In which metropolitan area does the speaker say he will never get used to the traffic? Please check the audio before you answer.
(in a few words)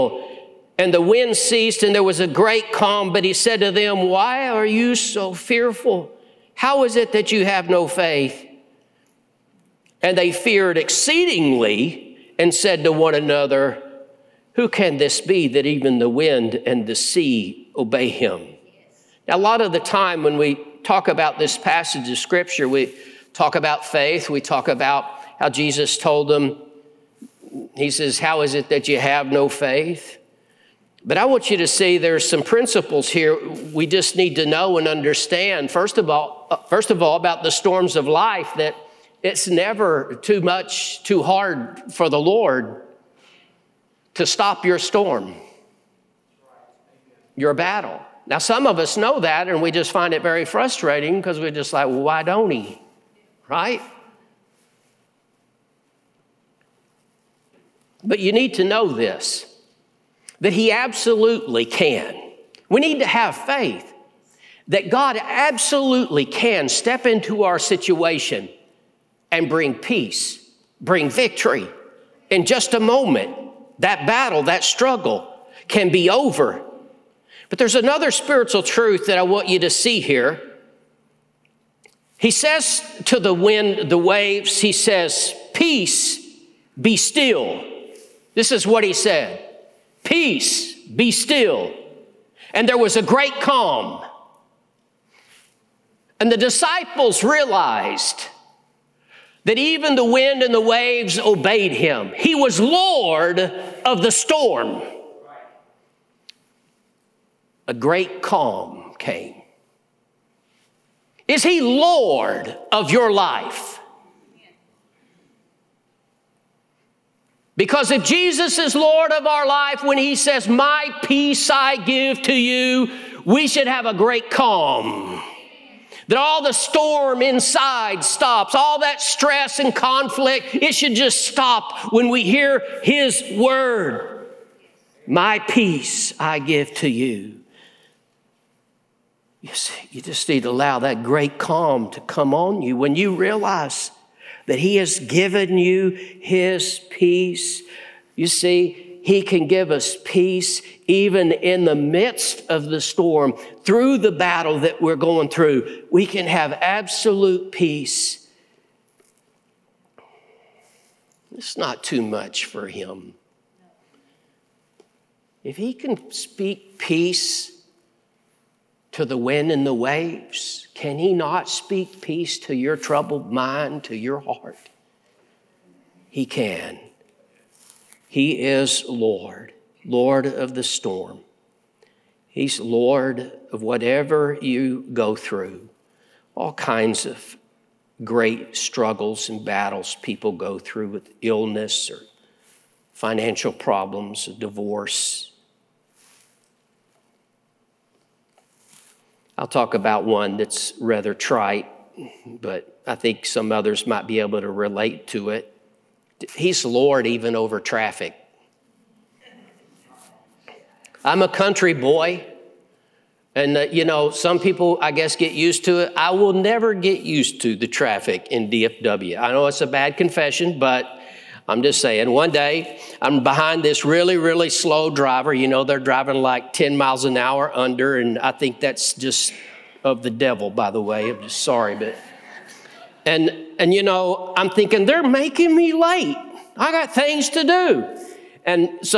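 DFW.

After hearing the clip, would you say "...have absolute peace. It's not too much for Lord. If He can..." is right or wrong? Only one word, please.
wrong.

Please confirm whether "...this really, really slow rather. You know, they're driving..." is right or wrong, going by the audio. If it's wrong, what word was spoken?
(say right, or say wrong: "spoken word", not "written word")
wrong: "driver", not "rather".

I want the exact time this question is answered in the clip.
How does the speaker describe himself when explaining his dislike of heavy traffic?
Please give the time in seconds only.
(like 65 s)
211 s.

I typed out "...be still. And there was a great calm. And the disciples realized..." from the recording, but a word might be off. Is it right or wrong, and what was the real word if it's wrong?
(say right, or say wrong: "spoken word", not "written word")
right.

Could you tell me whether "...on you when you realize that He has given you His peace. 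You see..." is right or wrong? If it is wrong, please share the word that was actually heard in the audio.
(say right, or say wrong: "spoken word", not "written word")
right.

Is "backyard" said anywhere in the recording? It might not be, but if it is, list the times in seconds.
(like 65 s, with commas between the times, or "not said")
not said.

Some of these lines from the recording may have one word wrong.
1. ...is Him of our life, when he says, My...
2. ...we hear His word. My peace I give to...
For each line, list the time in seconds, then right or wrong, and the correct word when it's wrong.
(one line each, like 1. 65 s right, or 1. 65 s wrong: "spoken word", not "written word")
1. 118 s wrong: "Lord", not "Him"
2. 132 s right.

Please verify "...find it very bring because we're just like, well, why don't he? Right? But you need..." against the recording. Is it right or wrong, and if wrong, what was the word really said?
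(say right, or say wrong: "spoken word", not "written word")
wrong: "frustrating", not "bring".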